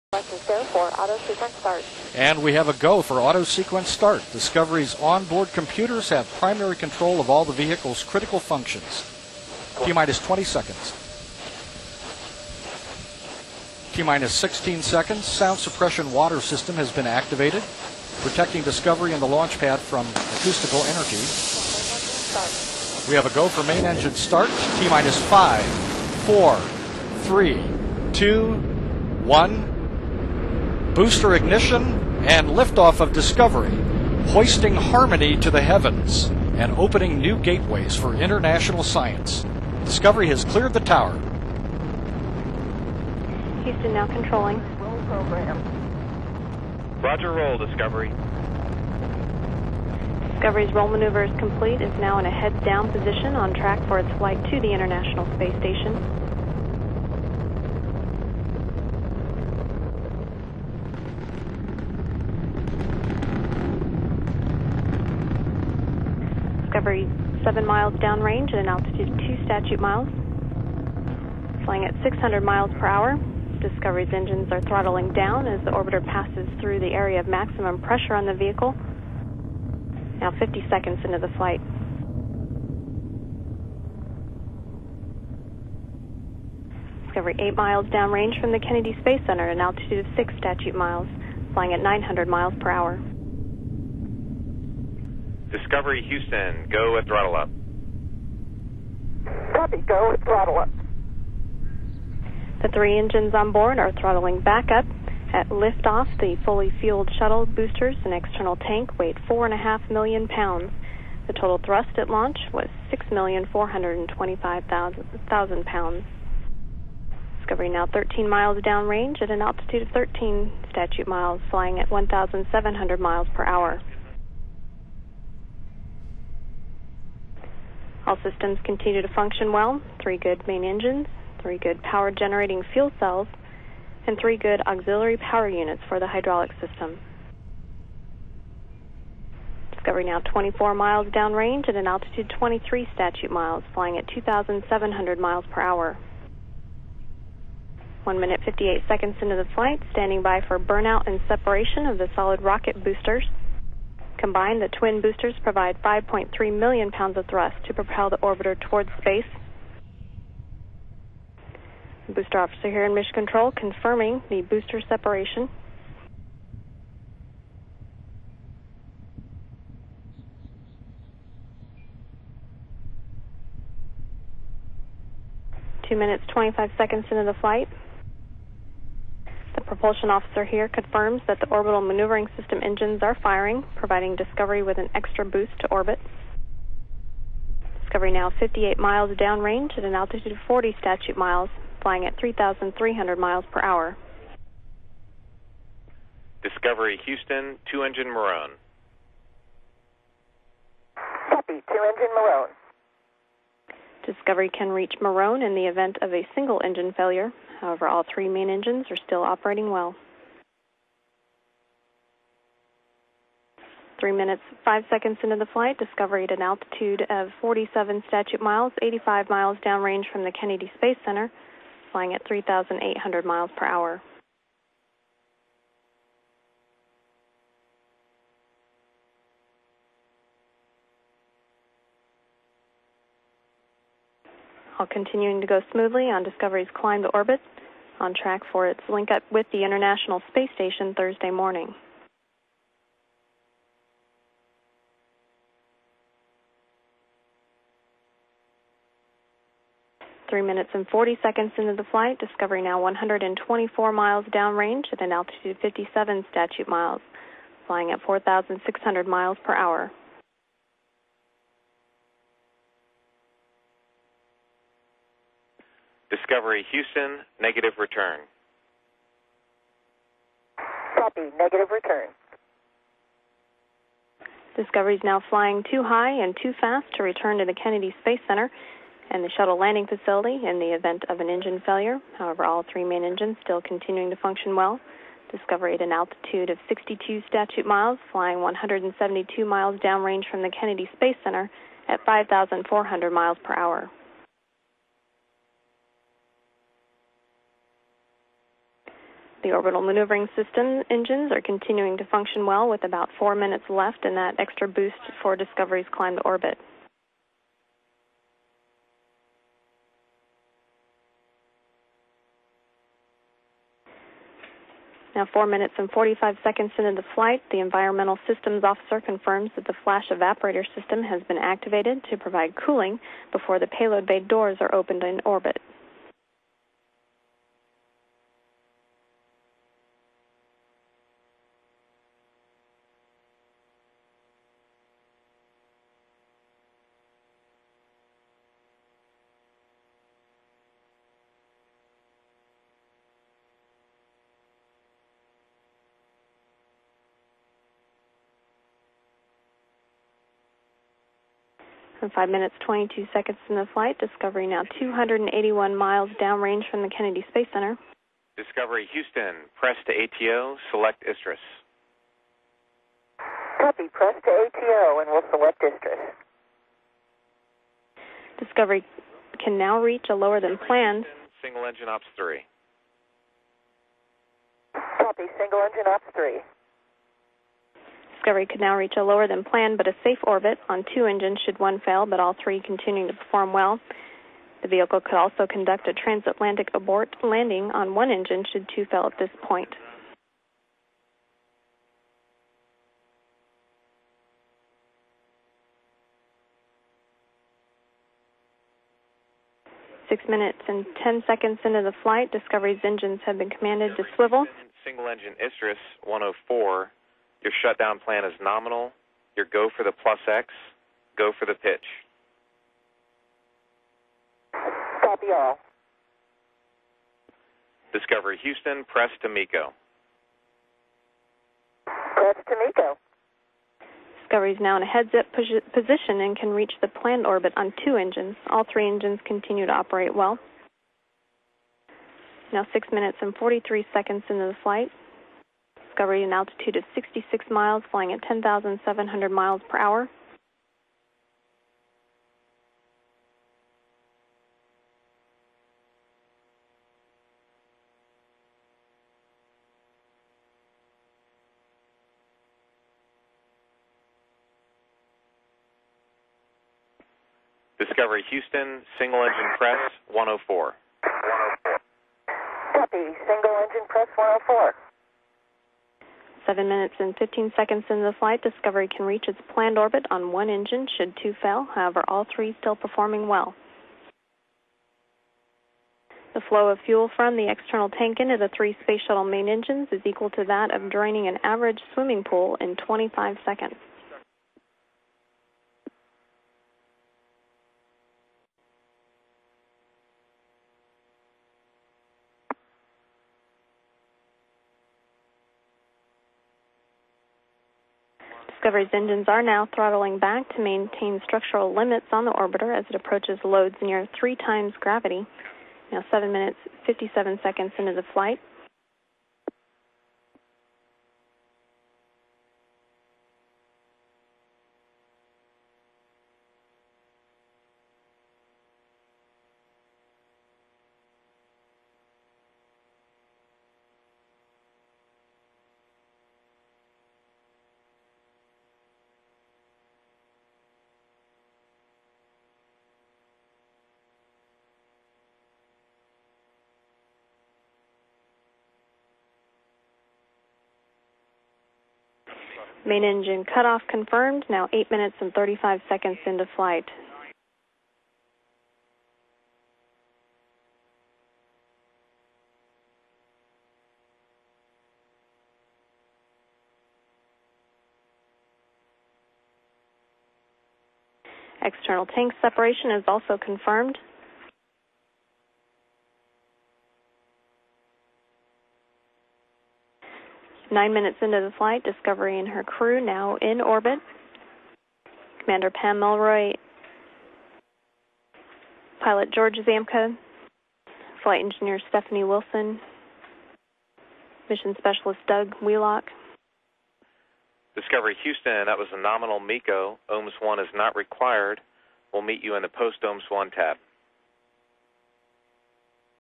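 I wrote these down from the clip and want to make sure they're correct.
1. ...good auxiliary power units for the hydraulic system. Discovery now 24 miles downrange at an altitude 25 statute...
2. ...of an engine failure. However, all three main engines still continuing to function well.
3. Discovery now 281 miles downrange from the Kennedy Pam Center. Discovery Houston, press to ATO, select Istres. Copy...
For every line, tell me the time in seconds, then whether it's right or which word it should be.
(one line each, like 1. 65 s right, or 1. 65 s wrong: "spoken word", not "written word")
1. 134 s wrong: "23", not "25"
2. 281 s right
3. 353 s wrong: "Space", not "Pam".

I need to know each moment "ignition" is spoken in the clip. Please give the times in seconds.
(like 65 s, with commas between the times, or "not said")
31 s.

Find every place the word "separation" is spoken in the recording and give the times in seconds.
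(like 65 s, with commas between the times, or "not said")
151 s, 164 s, 562 s.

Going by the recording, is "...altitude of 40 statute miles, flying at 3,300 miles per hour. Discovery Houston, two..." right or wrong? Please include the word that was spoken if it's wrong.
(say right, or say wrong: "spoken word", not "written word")
right.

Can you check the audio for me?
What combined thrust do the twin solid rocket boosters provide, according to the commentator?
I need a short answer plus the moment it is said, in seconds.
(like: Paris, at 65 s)
5.3 million pounds, at 155 s.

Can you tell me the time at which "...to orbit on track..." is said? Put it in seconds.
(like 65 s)
237 s.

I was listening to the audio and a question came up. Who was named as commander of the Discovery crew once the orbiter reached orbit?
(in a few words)
Pam Melroy.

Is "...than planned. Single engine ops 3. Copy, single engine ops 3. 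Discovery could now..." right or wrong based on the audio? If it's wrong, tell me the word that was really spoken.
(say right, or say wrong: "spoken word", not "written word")
right.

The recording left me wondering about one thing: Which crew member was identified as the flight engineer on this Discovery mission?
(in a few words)
Stephanie Wilson.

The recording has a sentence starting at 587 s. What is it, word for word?
Discovery Houston, that was a nominal MECO.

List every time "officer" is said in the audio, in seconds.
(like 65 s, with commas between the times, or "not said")
162 s, 180 s, 318 s.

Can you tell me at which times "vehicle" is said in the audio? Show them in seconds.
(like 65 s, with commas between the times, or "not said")
7 s, 78 s, 384 s.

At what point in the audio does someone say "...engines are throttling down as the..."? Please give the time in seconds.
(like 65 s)
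74 s.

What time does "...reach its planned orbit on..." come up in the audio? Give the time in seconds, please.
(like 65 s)
469 s.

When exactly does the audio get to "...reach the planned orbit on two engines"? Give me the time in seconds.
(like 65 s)
426 s.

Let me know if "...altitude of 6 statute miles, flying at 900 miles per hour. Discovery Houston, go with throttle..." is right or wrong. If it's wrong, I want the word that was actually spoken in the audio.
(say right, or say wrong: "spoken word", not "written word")
right.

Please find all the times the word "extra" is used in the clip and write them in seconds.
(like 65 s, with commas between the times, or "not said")
184 s, 304 s.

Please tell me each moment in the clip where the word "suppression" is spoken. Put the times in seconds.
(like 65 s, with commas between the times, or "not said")
15 s.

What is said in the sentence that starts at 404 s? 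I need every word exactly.
Single engine Istres 104 your shutdown plan is nominal.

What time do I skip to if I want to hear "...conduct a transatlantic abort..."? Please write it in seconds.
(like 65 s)
385 s.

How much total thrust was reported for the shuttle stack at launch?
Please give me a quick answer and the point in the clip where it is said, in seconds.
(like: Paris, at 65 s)
6,425,000 pounds, at 112 s.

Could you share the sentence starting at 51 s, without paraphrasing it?
It's now in a heads down position on track for its flight to the International Space Station.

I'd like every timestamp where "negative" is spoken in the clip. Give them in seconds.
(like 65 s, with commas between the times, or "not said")
267 s, 271 s.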